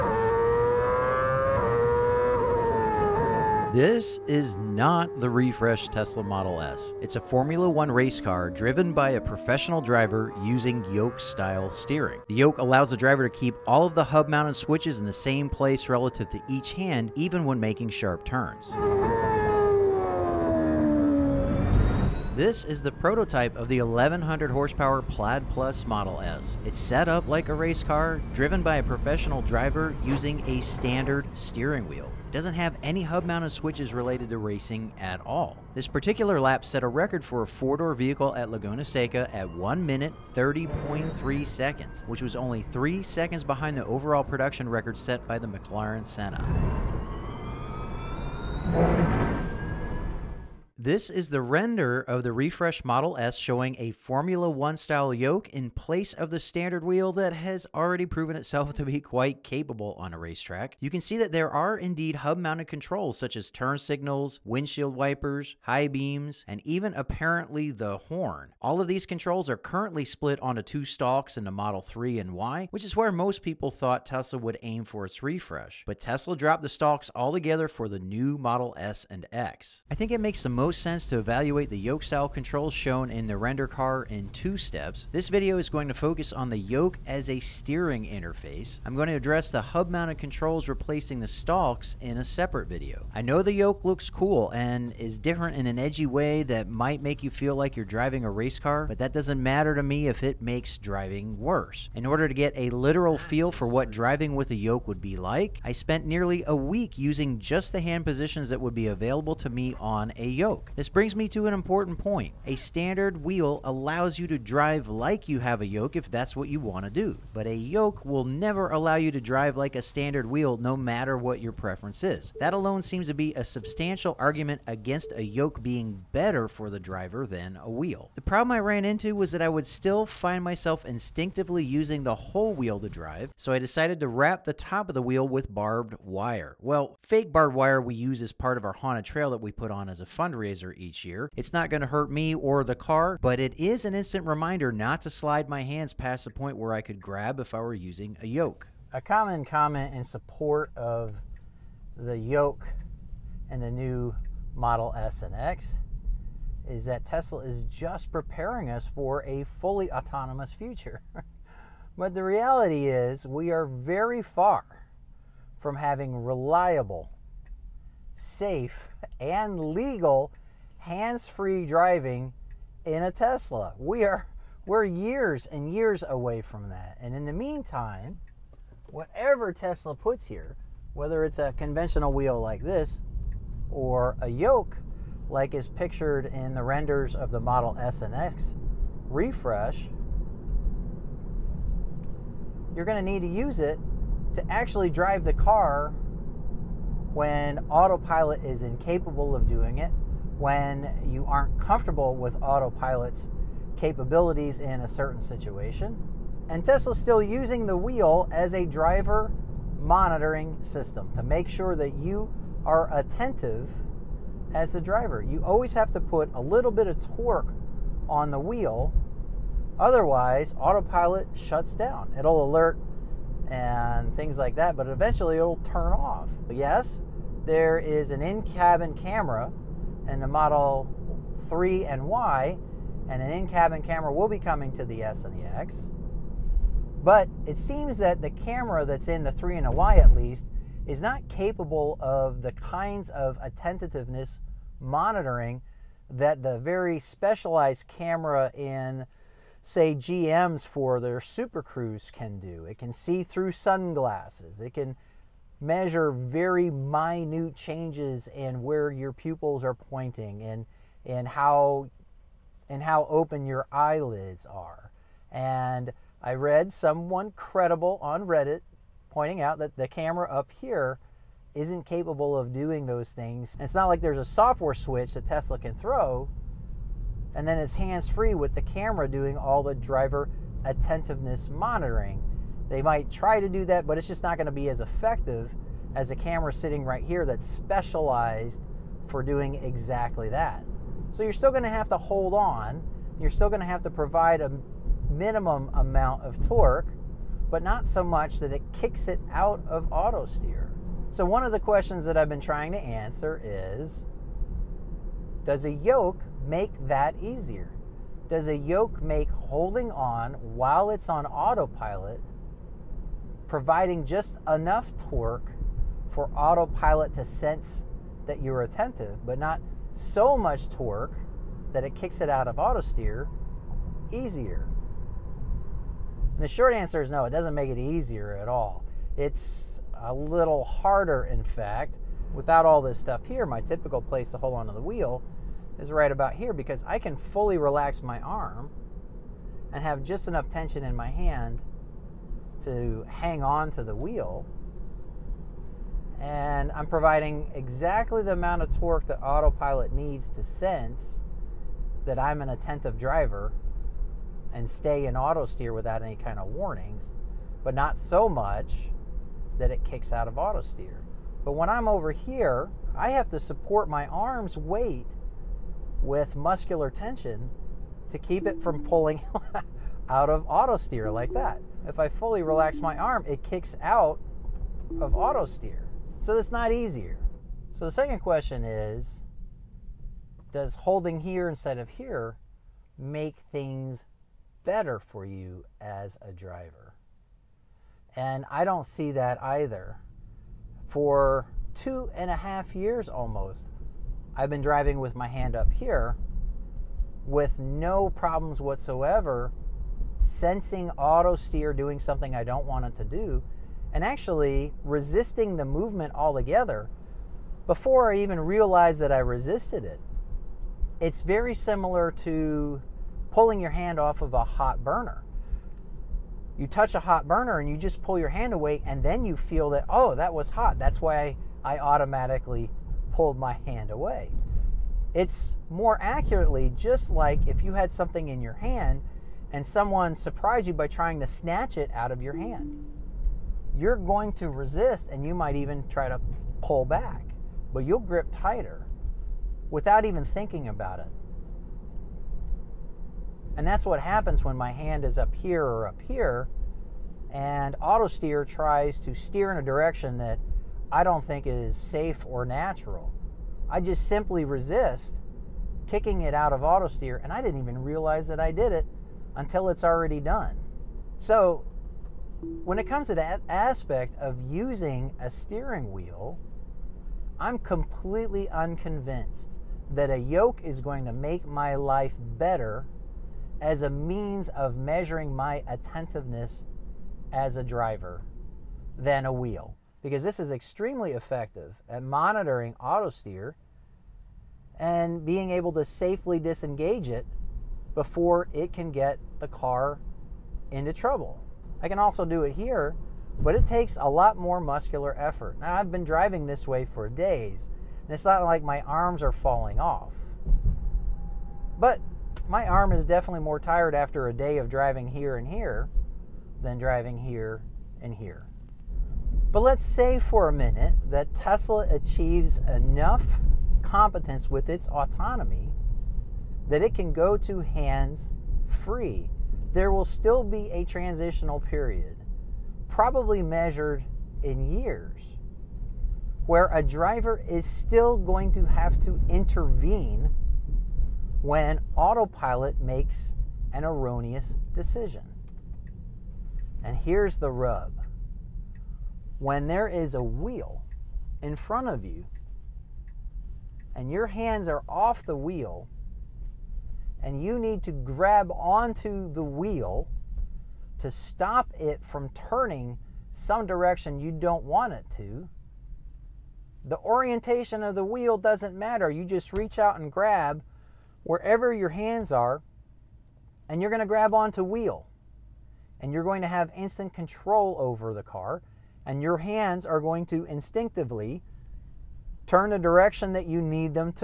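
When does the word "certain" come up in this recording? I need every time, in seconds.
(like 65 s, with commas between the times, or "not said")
204 s.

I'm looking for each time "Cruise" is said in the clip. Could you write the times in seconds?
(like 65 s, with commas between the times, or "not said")
251 s.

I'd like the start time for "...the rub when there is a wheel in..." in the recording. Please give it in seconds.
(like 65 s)
537 s.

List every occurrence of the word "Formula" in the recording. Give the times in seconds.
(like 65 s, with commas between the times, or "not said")
7 s, 53 s.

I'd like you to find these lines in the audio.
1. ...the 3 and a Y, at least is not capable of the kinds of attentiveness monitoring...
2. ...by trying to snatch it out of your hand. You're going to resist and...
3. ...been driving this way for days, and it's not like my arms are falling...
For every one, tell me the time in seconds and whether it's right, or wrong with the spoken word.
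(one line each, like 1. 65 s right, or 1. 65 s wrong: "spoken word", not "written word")
1. 239 s right
2. 430 s right
3. 495 s right.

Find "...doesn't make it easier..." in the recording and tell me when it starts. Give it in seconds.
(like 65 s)
327 s.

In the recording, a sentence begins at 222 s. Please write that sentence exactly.
It'll alert and things like that, but eventually it'll turn off.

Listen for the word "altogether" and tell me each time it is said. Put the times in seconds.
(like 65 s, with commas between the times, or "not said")
77 s, 406 s.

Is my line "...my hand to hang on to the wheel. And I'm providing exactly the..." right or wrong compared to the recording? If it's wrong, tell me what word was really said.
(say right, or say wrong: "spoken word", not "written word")
right.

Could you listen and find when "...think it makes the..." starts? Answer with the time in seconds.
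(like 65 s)
79 s.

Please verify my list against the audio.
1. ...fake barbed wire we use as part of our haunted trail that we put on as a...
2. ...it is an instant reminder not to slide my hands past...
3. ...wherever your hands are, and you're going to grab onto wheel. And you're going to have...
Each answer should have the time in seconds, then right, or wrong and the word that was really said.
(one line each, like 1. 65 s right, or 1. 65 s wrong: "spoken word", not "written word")
1. 137 s right
2. 143 s right
3. 561 s right.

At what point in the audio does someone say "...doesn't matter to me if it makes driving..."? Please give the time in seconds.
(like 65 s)
99 s.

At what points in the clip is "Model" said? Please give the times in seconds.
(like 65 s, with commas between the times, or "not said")
6 s, 25 s, 52 s, 71 s, 78 s, 154 s, 187 s, 230 s.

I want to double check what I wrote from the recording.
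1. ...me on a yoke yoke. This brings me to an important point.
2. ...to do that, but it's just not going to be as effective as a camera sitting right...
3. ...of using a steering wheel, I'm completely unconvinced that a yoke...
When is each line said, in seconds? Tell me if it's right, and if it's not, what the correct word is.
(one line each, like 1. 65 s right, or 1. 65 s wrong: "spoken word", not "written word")
1. 109 s right
2. 283 s right
3. 464 s right.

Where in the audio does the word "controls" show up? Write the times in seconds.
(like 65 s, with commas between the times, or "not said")
62 s, 69 s, 82 s, 90 s, 567 s.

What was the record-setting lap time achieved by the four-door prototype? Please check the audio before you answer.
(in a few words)
1 minute 30.3 seconds.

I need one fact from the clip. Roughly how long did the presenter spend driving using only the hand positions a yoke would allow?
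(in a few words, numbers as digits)
nearly a week.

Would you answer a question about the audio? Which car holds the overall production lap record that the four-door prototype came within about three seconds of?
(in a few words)
McLaren Senna.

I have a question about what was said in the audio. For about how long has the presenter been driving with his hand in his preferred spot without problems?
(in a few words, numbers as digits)
two and a half years.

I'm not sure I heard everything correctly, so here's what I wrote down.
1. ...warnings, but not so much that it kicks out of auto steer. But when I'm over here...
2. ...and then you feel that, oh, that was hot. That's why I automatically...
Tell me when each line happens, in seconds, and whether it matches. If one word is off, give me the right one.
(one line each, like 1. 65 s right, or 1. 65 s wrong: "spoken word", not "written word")
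1. 356 s right
2. 418 s right.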